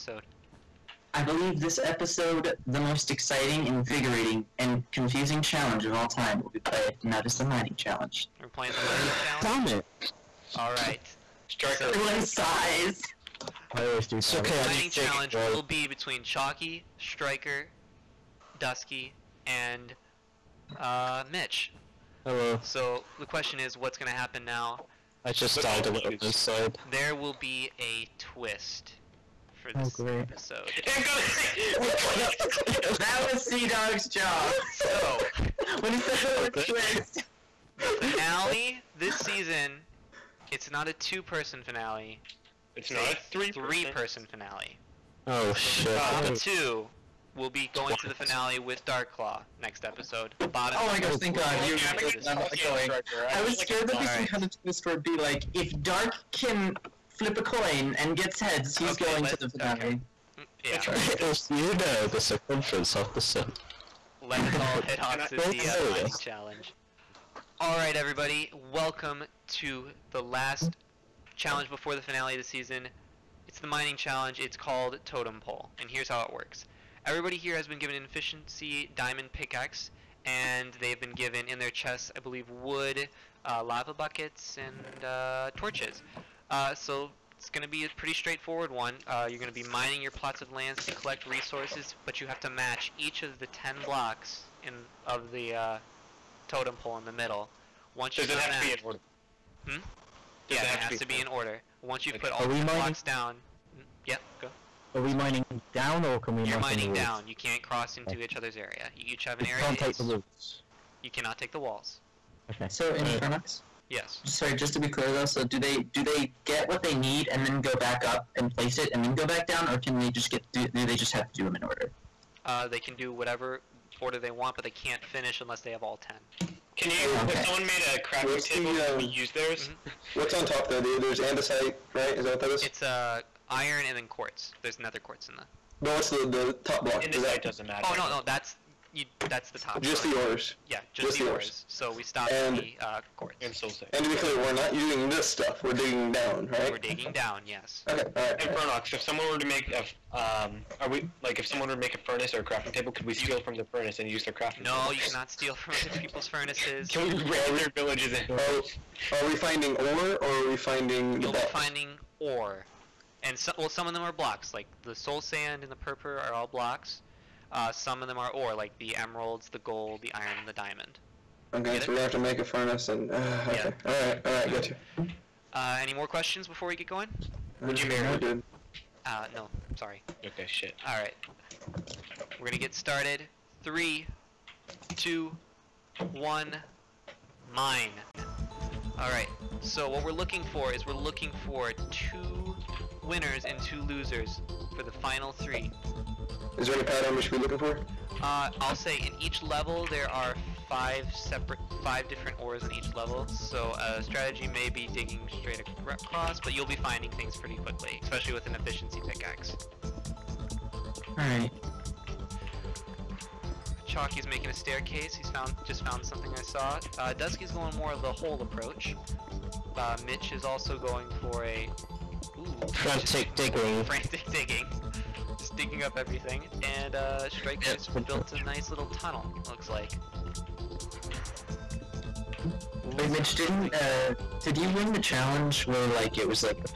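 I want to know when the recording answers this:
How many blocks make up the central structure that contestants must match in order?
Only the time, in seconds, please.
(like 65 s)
93 s.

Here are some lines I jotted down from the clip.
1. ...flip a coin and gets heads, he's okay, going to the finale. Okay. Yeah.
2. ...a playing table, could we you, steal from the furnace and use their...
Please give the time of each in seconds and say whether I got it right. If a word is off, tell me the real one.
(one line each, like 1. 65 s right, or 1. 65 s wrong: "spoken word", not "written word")
1. 57 s right
2. 152 s wrong: "crafting", not "playing".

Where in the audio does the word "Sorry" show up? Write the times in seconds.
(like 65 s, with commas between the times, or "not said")
114 s, 179 s.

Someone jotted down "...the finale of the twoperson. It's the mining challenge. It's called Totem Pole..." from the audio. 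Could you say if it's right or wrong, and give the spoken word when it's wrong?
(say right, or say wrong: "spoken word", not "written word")
wrong: "season", not "twoperson".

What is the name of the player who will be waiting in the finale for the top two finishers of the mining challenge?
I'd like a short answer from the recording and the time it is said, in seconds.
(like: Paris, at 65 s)
Darkclaw, at 48 s.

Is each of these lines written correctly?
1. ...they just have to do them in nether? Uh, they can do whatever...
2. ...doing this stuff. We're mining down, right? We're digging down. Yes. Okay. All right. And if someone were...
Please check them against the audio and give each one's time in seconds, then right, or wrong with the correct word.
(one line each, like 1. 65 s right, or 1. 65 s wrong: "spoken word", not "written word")
1. 120 s wrong: "order", not "nether"
2. 144 s wrong: "digging", not "mining".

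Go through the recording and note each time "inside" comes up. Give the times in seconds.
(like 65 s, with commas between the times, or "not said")
26 s.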